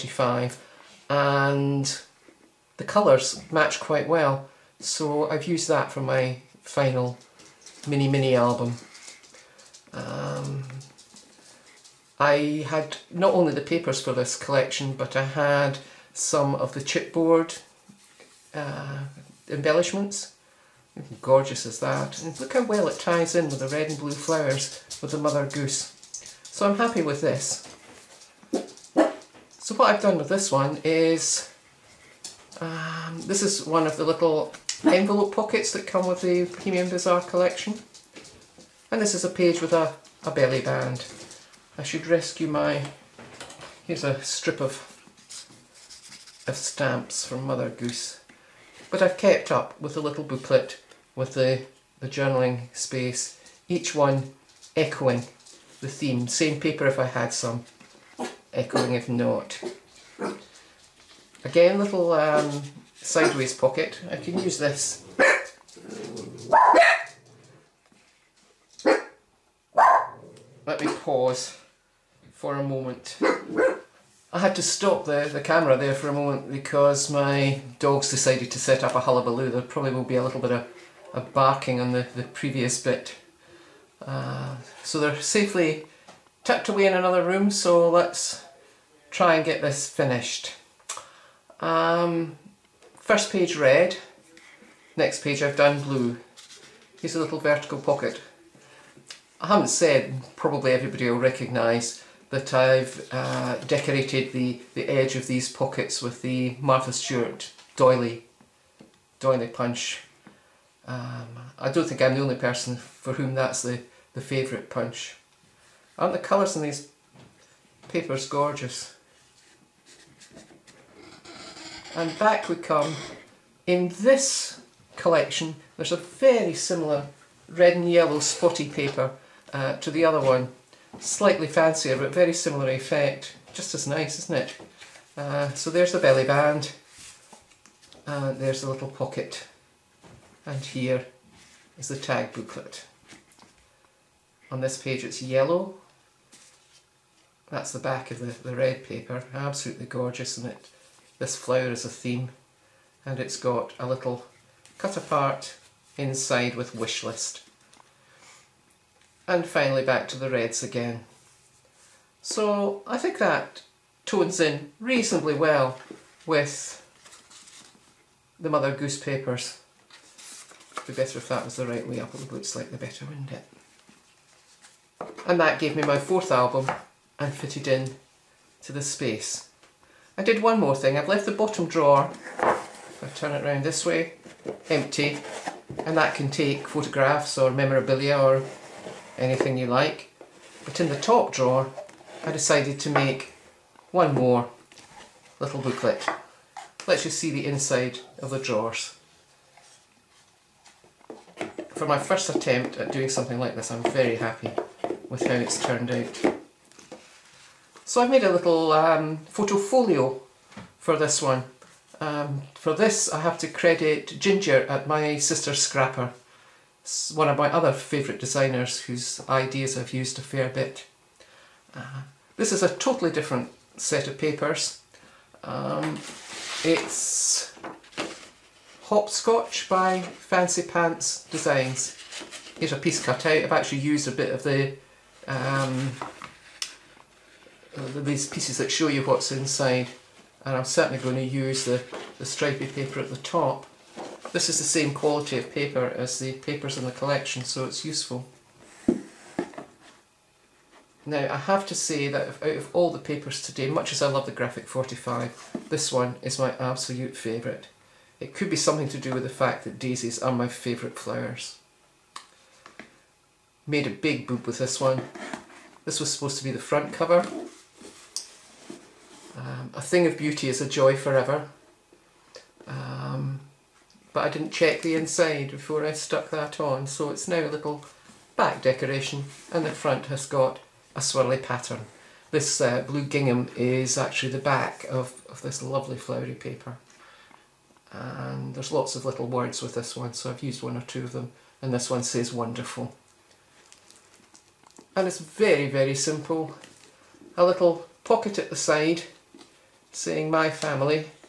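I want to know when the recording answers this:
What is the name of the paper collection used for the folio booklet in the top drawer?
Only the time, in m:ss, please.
3:48.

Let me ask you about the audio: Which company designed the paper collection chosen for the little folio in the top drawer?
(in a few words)
Fancy Pants Designs.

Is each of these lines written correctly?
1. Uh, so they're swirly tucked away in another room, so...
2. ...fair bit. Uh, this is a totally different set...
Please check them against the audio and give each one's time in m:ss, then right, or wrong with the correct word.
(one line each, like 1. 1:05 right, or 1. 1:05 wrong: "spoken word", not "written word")
1. 1:24 wrong: "safely", not "swirly"
2. 3:40 right.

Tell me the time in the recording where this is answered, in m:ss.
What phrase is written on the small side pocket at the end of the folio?
5:00.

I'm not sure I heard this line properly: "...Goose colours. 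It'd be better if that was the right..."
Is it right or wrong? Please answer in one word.
wrong.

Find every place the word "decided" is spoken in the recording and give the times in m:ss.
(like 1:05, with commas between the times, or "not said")
1:18, 3:12.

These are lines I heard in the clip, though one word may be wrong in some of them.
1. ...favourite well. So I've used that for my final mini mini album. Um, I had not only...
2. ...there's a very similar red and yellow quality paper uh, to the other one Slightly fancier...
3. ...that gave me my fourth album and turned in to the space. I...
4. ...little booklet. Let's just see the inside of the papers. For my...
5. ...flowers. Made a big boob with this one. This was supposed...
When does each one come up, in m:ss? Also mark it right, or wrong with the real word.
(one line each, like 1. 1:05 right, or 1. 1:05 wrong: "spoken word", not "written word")
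1. 0:03 wrong: "quite", not "favourite"
2. 2:05 wrong: "spotty", not "quality"
3. 2:55 wrong: "fitted", not "turned"
4. 3:15 wrong: "drawers", not "papers"
5. 4:20 right.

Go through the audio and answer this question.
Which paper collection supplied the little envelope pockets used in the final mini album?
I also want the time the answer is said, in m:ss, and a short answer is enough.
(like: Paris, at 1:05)
Bohemian Bazaar, at 0:36.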